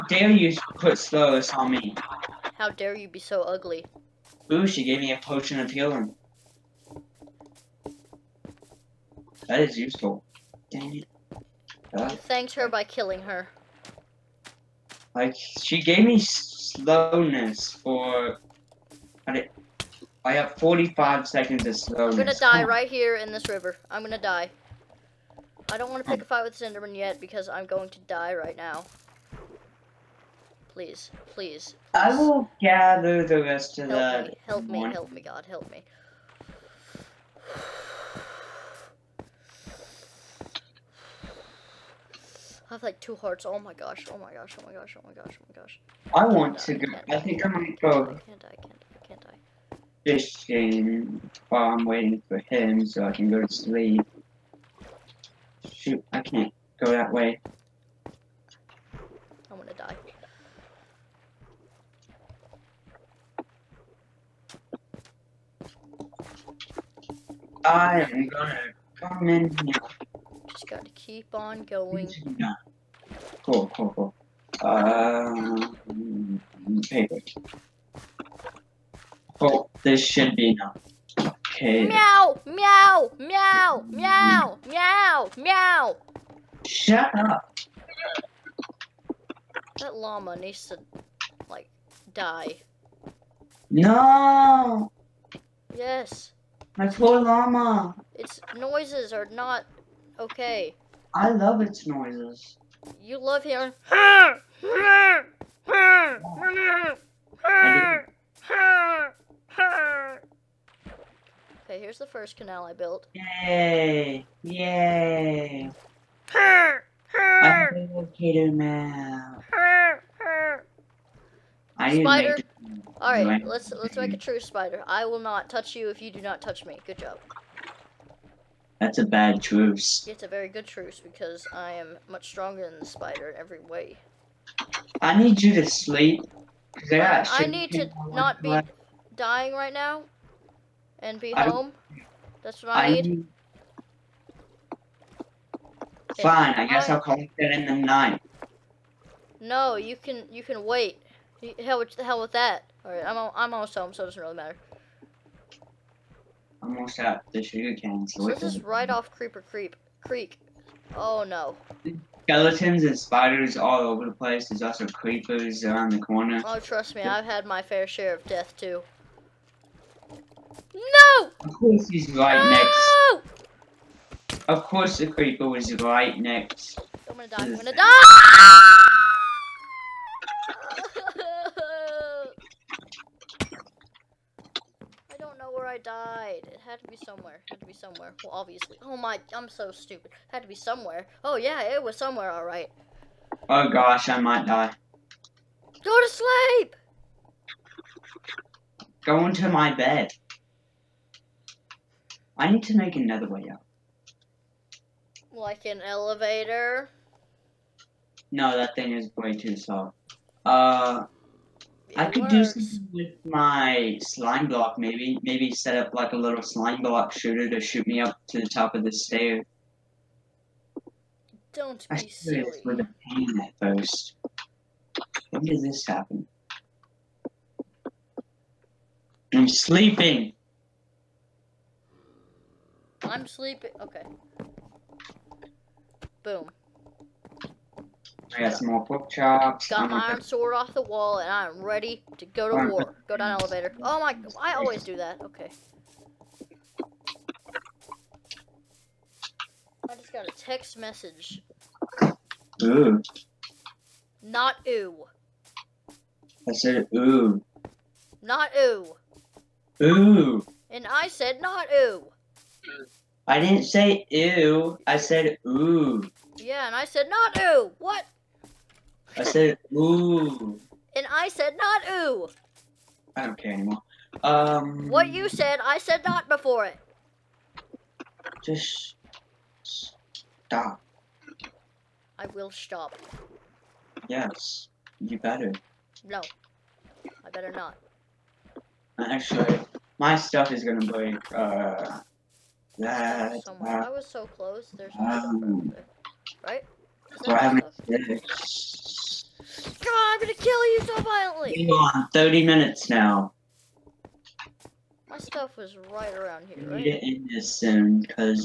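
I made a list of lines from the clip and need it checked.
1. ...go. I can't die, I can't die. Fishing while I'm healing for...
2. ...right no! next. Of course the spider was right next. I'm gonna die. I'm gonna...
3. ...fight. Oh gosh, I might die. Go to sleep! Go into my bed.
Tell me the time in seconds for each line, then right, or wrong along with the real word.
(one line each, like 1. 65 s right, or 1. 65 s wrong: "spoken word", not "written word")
1. 47 s wrong: "waiting", not "healing"
2. 172 s wrong: "creeper", not "spider"
3. 192 s wrong: "alright", not "fight".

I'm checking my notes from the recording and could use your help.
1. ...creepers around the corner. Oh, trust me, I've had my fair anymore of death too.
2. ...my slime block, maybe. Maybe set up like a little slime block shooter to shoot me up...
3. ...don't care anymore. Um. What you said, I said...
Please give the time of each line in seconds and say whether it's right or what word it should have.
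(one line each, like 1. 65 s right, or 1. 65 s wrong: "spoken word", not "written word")
1. 164 s wrong: "share", not "anymore"
2. 213 s right
3. 273 s right.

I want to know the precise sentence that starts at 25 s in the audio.
I don't want to pick a fight with Cinderman yet because I'm going to die right now.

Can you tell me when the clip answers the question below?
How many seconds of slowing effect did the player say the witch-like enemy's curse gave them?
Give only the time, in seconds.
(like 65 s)
20 s.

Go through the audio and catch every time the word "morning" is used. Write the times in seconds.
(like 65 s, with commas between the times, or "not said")
34 s.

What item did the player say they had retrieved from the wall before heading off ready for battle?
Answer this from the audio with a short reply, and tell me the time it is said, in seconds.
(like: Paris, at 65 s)
iron sword, at 240 s.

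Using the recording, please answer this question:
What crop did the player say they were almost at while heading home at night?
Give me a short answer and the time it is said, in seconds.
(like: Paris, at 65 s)
sugar cane, at 157 s.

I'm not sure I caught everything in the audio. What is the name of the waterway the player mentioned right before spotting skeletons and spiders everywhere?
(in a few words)
Creeper Creep Creek.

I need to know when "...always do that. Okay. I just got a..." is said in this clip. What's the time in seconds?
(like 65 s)
244 s.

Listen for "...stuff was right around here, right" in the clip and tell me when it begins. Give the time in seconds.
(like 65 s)
305 s.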